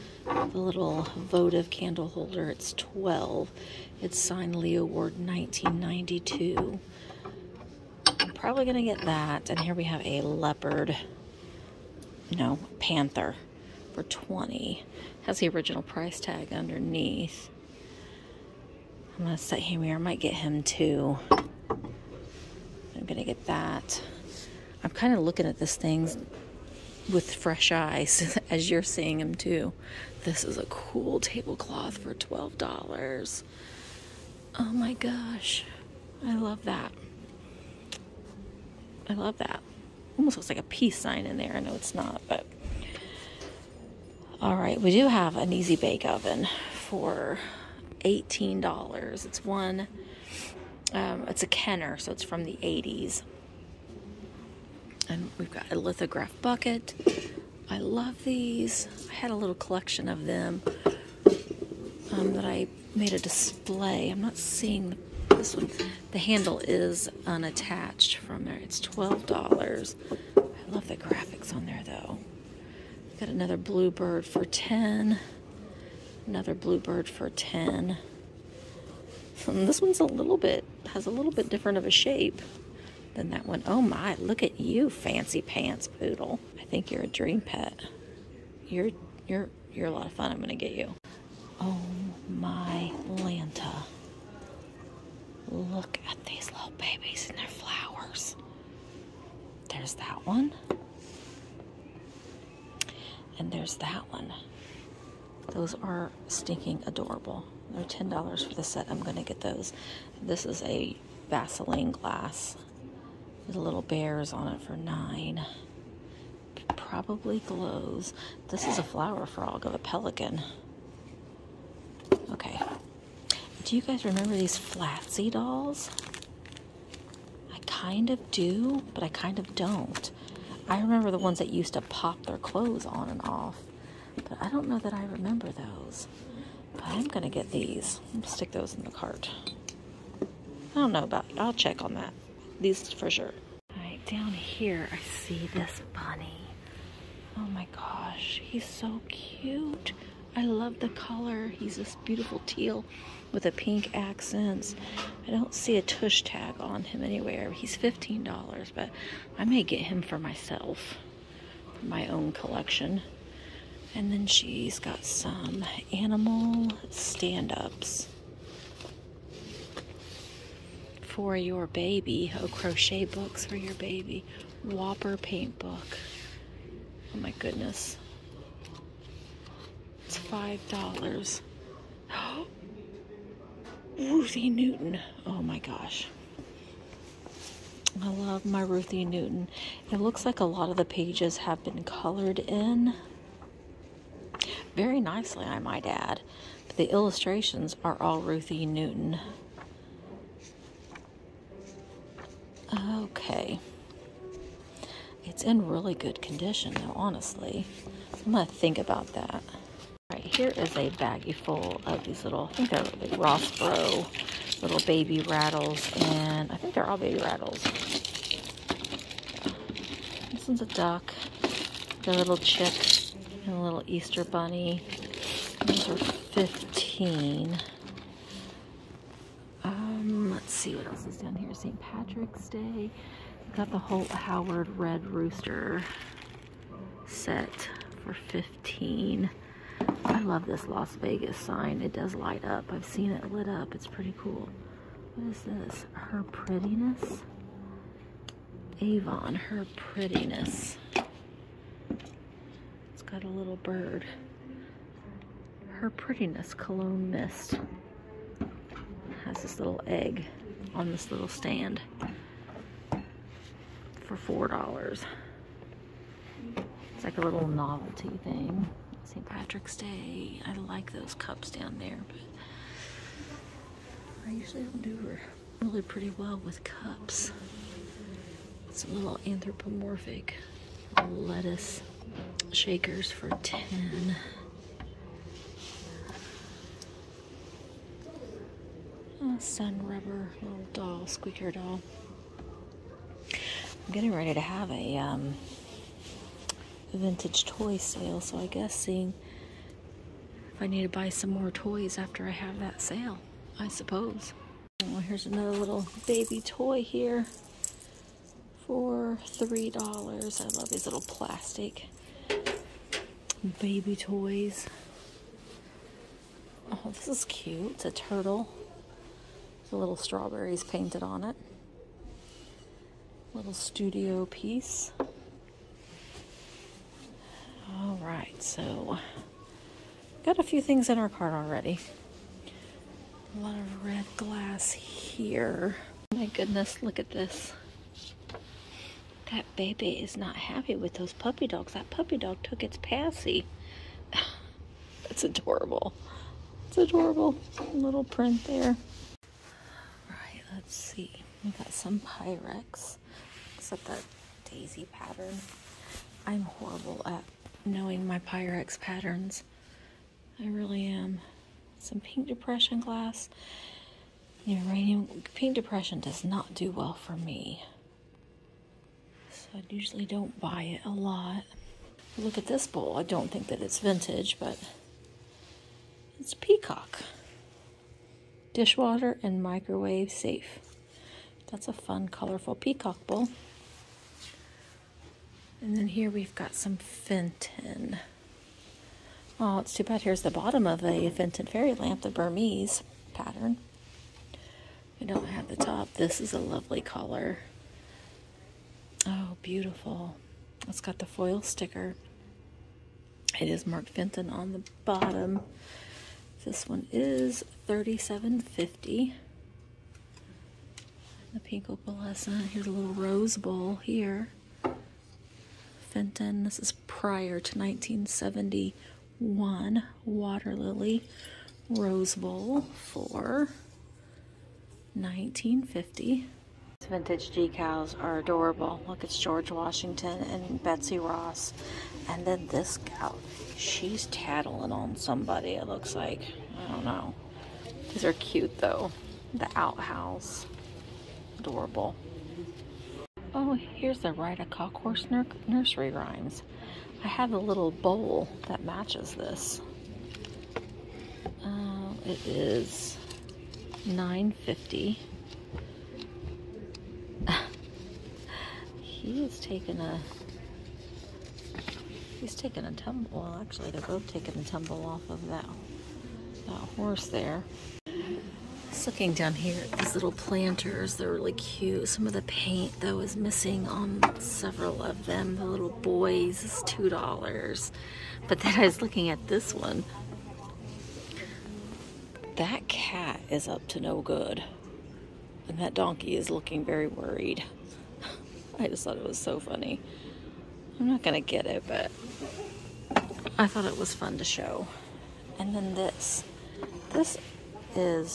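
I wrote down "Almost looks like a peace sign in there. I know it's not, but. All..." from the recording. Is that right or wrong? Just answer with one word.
right.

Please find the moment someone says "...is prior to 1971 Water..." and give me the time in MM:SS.
06:56.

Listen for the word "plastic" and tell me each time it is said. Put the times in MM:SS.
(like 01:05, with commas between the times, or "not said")
05:11.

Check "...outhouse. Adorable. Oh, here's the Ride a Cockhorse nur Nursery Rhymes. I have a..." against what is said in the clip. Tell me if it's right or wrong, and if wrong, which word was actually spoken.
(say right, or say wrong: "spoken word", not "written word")
right.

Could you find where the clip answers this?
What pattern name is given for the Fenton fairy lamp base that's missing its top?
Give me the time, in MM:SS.
06:32.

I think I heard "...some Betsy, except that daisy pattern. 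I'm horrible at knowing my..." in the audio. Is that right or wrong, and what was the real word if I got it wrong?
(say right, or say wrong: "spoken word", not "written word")
wrong: "Pyrex", not "Betsy".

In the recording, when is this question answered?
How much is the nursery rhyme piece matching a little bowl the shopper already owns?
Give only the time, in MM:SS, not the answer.
07:33.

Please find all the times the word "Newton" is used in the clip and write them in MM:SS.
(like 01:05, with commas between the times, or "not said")
03:04, 03:09, 03:18.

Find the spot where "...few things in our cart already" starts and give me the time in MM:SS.
05:30.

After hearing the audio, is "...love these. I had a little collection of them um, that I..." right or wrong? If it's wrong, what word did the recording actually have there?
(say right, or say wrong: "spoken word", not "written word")
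right.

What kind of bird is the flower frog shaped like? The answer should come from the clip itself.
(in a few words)
Pelican.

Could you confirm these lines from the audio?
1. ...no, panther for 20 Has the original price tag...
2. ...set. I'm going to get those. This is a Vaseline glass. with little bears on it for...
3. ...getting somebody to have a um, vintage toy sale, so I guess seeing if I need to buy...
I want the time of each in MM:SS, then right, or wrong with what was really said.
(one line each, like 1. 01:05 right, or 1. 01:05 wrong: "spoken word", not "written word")
1. 00:12 right
2. 01:48 right
3. 04:53 wrong: "ready", not "somebody".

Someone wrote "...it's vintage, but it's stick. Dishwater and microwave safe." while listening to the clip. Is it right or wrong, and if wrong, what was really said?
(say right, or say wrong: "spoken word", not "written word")
wrong: "peacock", not "stick".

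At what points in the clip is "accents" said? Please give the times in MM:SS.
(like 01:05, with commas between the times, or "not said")
02:33.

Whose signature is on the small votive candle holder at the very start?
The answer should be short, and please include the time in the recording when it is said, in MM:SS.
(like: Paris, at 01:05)
Leo Ward, at 00:04.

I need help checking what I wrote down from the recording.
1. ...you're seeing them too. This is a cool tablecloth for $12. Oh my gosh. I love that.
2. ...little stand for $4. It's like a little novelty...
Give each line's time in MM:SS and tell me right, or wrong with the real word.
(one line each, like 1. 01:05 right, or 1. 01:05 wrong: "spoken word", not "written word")
1. 00:28 right
2. 04:21 right.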